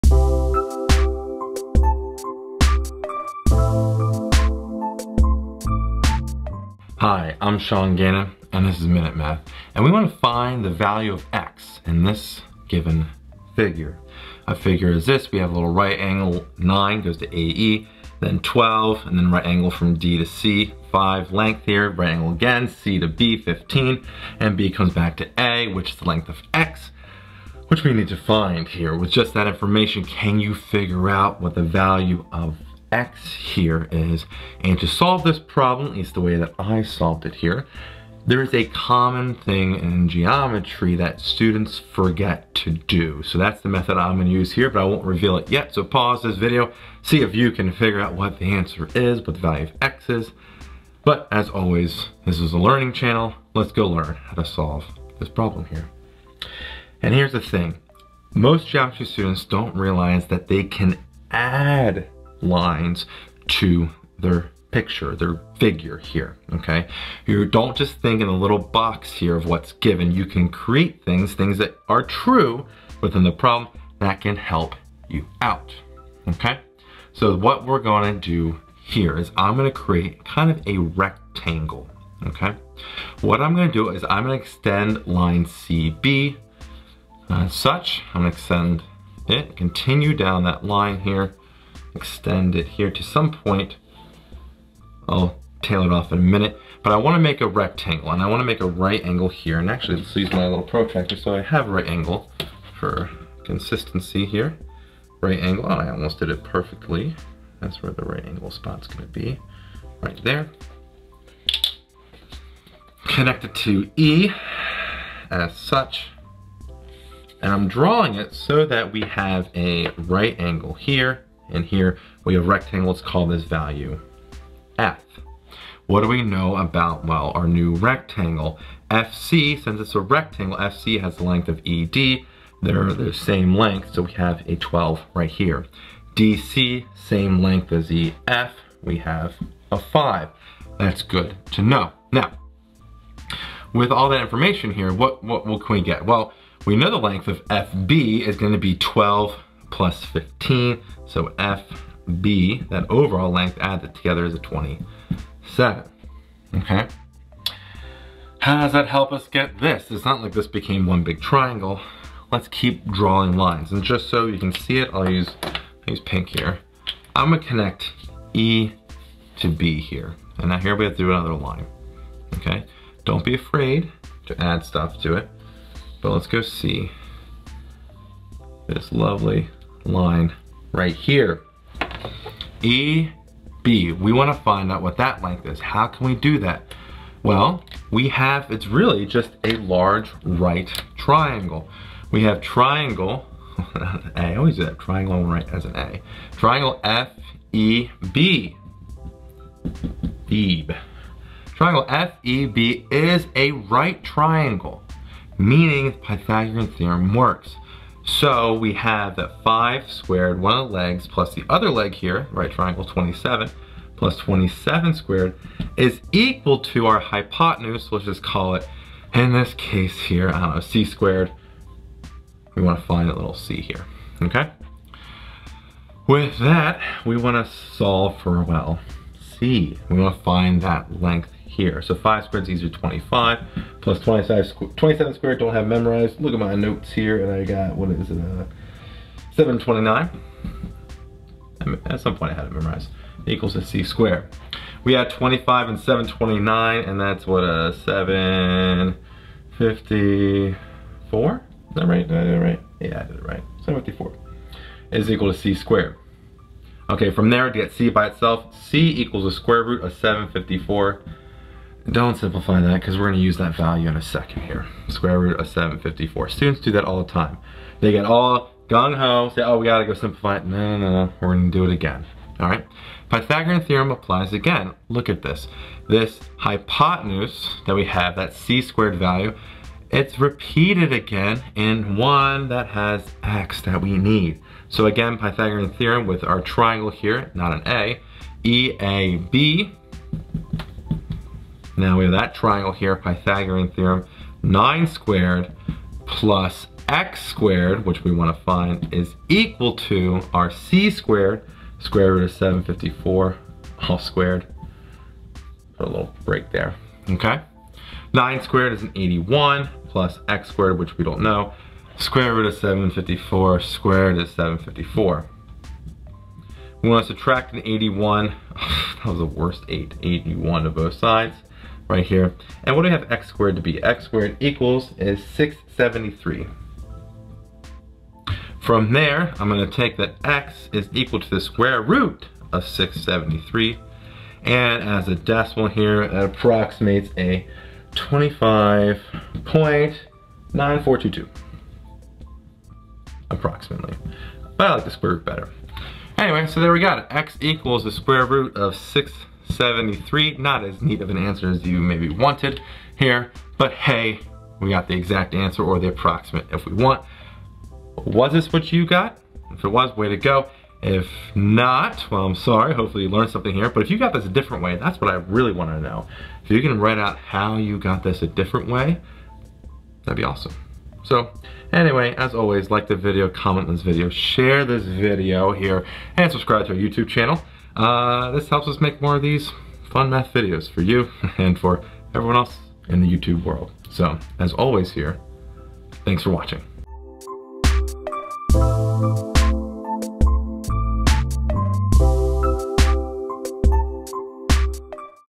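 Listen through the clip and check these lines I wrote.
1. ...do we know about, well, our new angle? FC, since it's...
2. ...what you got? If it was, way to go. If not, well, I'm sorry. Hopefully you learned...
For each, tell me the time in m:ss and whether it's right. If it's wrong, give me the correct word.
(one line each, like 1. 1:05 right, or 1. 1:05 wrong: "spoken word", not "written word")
1. 2:06 wrong: "rectangle", not "angle"
2. 5:58 right.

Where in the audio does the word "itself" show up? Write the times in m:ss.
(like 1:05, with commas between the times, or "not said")
4:18.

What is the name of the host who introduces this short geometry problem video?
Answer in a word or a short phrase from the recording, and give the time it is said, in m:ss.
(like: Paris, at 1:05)
Sean Gannon, at 0:07.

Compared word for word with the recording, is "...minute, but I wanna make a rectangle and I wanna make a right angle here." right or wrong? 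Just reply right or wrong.
right.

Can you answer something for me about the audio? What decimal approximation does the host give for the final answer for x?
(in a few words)
25.9422.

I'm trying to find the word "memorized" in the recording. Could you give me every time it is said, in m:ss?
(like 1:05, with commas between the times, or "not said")
3:55, 4:02.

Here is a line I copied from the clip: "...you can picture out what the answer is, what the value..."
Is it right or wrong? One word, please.
wrong.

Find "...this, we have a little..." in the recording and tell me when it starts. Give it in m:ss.
0:15.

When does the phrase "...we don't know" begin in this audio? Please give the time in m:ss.
5:10.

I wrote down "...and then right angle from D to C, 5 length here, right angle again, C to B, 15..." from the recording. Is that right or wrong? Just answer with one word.
right.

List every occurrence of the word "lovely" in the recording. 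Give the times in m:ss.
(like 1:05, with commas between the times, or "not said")
2:58.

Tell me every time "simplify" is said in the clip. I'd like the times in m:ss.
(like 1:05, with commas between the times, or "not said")
4:22, 4:29.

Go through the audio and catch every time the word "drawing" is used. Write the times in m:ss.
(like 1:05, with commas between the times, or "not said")
1:57, 2:42.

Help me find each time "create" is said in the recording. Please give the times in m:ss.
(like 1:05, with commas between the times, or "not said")
1:10, 1:19.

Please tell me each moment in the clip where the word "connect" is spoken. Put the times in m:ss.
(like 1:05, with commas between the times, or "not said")
1:53, 2:47.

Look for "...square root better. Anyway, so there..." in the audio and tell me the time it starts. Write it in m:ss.
5:44.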